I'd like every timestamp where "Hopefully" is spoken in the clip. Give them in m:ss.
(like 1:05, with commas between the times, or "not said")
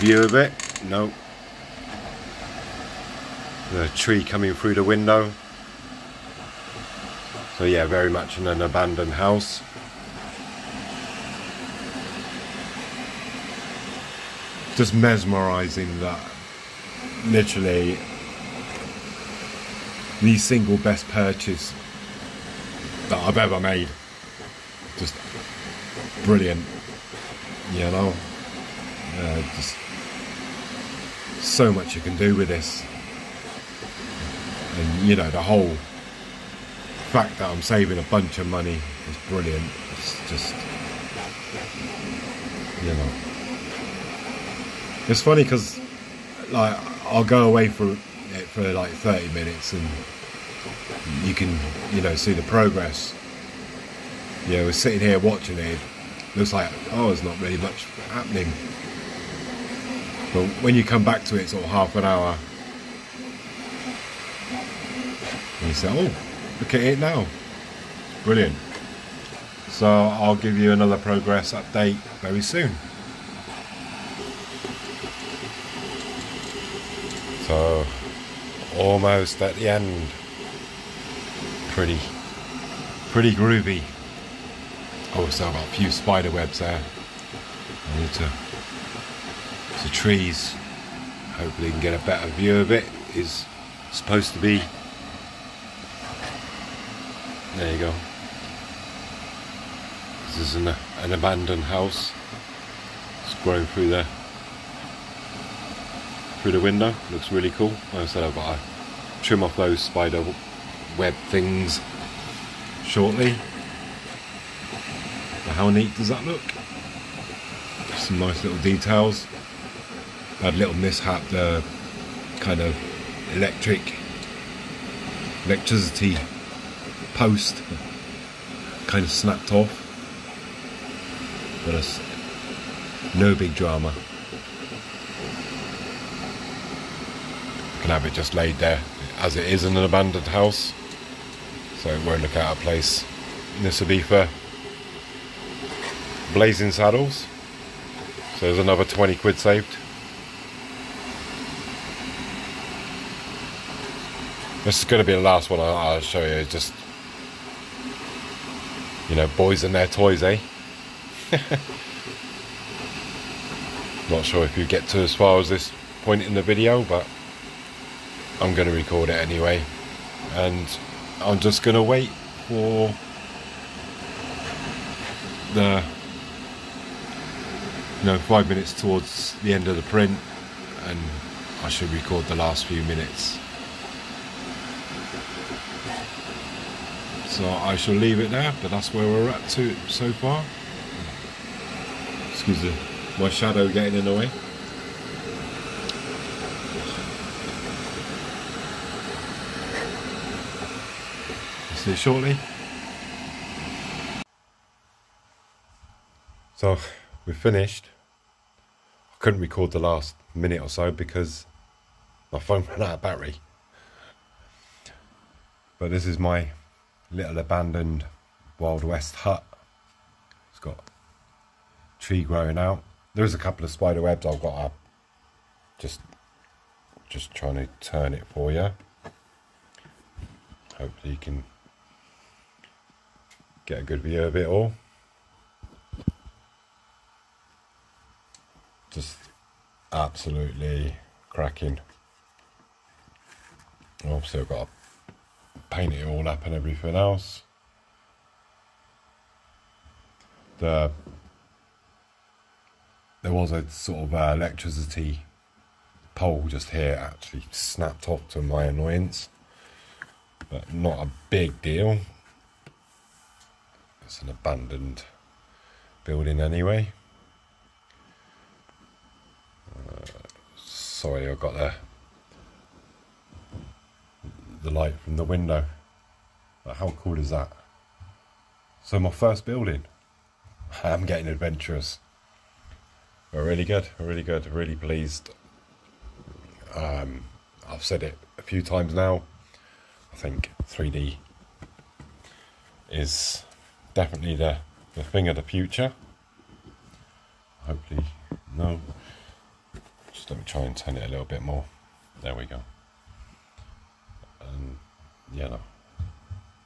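1:31, 3:50, 4:57.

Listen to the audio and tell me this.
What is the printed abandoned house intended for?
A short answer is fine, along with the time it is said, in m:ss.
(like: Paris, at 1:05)
Blazing Saddles, at 2:26.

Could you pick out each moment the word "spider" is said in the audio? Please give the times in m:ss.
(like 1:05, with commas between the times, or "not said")
1:25, 1:49, 3:43.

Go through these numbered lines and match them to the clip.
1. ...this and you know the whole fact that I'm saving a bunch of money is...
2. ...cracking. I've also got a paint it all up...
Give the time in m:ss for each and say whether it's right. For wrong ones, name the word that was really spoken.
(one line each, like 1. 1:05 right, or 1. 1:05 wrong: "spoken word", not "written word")
1. 0:32 right
2. 4:01 right.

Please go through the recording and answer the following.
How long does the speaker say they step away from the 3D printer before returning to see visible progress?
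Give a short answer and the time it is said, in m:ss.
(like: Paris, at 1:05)
30 minutes, at 0:48.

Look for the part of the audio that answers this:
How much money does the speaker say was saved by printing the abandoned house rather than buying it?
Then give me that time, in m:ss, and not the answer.
2:28.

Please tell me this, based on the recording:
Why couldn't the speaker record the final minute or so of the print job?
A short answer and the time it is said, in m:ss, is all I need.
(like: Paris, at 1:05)
phone ran out of battery, at 3:32.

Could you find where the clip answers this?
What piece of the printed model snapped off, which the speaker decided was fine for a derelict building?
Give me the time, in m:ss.
4:14.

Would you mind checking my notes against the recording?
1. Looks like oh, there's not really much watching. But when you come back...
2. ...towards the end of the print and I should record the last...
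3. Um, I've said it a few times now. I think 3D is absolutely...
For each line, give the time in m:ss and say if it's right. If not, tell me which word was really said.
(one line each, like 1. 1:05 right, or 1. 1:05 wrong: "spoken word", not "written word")
1. 0:56 wrong: "happening", not "watching"
2. 2:58 right
3. 4:46 wrong: "definitely", not "absolutely".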